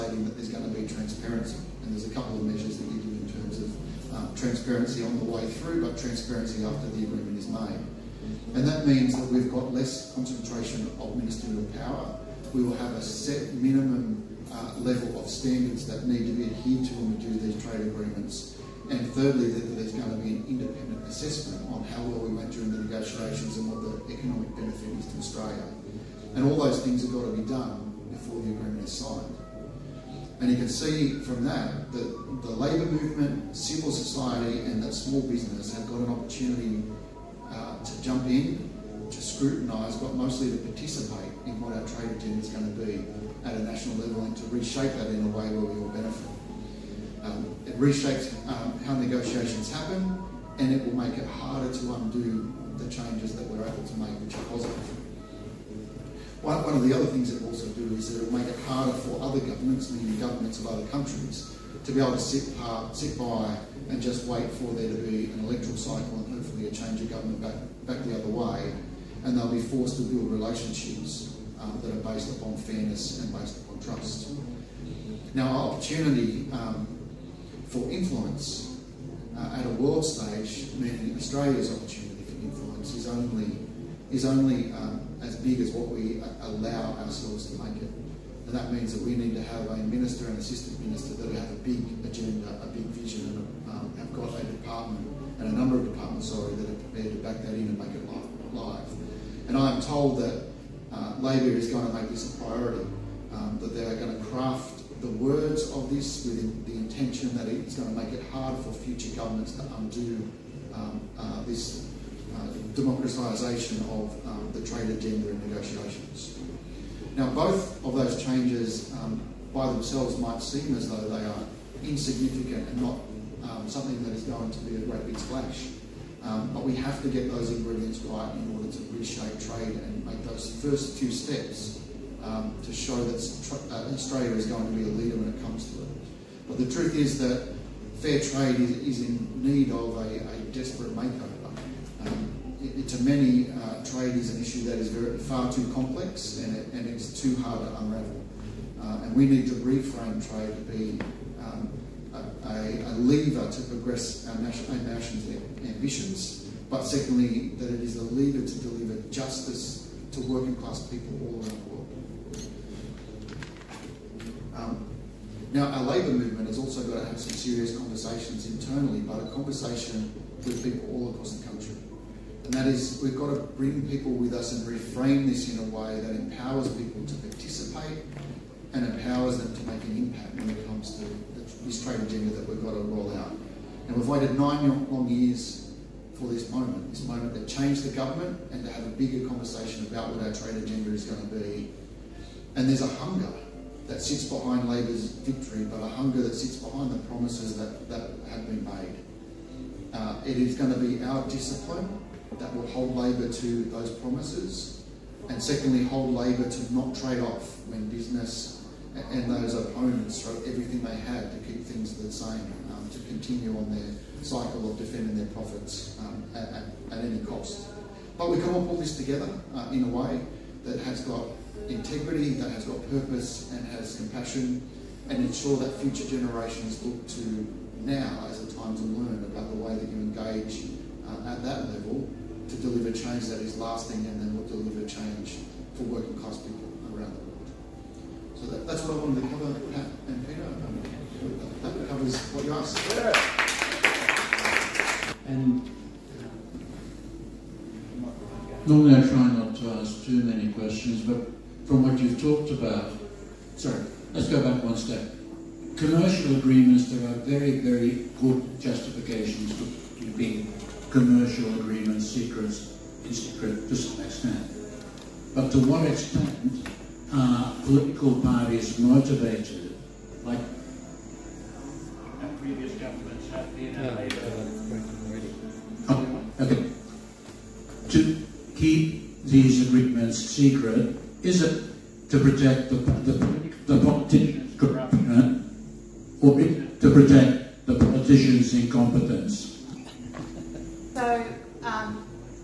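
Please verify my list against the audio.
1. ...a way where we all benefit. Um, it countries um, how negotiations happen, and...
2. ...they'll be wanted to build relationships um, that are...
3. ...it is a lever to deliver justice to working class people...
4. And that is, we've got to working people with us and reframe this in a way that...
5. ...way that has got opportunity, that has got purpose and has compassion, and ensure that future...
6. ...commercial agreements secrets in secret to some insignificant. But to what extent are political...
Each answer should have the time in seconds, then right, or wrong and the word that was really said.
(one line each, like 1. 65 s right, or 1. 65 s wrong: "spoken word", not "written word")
1. 45 s wrong: "reshapes", not "countries"
2. 69 s wrong: "forced", not "wanted"
3. 157 s right
4. 172 s wrong: "bring", not "working"
5. 219 s wrong: "integrity", not "opportunity"
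6. 260 s wrong: "extent", not "insignificant".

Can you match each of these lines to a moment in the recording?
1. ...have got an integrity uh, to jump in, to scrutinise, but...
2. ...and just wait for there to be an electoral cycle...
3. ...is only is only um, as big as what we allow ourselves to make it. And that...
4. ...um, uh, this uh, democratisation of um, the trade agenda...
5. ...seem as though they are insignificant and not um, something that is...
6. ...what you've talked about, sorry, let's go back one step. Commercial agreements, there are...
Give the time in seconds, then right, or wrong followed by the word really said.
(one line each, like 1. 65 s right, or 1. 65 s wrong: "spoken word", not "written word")
1. 35 s wrong: "opportunity", not "integrity"
2. 63 s right
3. 82 s right
4. 110 s right
5. 120 s right
6. 251 s right.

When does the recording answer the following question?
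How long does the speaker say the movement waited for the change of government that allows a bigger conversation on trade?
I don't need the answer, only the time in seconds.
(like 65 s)
184 s.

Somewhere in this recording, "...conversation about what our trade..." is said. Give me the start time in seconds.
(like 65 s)
189 s.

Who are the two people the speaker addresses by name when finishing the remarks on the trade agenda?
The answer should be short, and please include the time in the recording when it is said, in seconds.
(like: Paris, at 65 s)
Pat and Peter, at 239 s.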